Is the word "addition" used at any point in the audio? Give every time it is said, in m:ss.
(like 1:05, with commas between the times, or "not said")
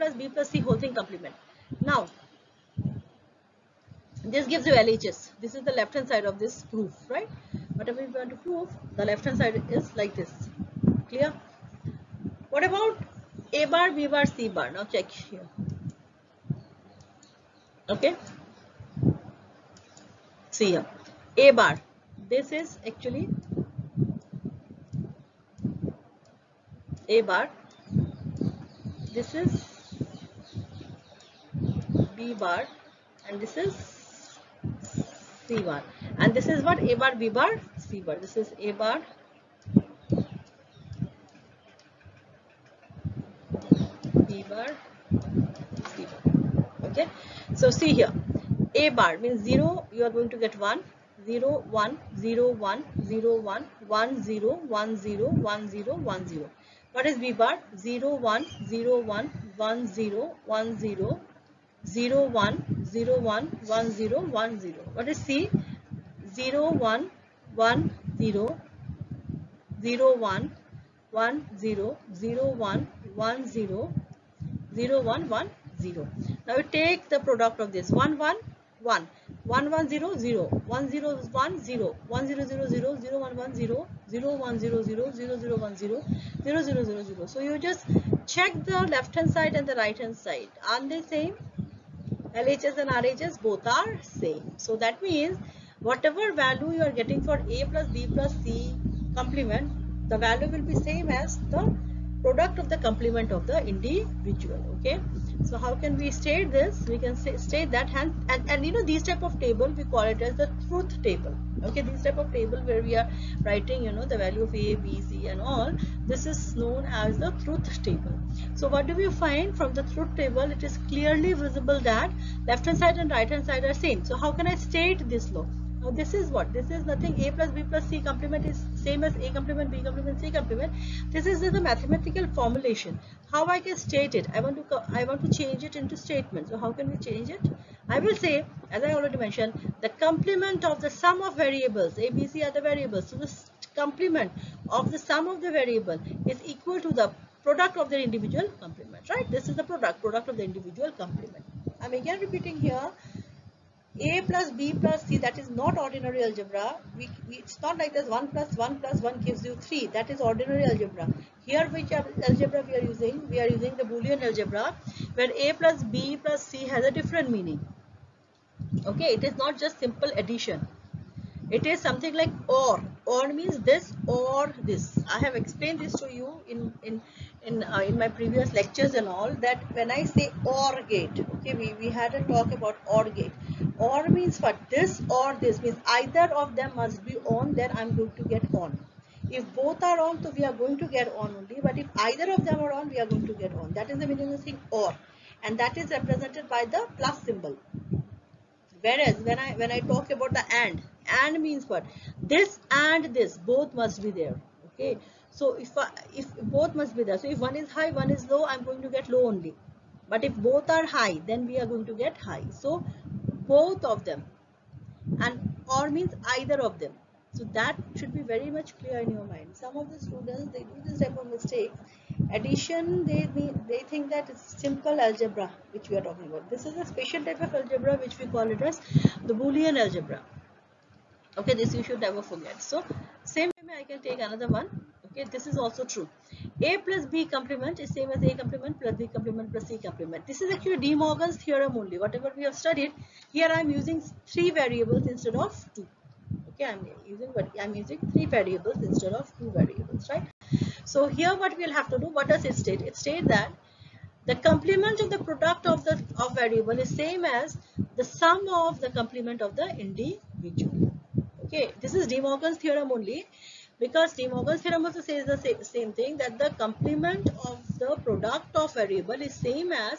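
2:50, 3:42.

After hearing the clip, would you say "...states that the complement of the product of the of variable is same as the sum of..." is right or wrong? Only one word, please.
right.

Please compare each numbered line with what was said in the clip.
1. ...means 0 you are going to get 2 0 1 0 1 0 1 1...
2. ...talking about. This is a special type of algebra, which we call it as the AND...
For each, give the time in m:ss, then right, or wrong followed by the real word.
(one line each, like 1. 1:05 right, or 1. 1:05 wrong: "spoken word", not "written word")
1. 0:49 wrong: "1", not "2"
2. 3:46 wrong: "Boolean", not "AND".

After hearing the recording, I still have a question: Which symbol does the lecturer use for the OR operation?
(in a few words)
plus symbol.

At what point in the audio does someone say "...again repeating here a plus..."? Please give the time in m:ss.
2:32.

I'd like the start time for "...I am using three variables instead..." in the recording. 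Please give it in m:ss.
4:03.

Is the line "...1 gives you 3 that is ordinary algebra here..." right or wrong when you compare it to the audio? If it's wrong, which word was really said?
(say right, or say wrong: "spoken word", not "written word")
right.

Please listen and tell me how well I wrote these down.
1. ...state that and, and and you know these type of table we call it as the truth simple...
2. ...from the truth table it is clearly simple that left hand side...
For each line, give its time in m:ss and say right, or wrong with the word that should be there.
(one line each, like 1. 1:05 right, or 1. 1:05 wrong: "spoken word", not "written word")
1. 1:47 wrong: "table", not "simple"
2. 1:59 wrong: "visible", not "simple".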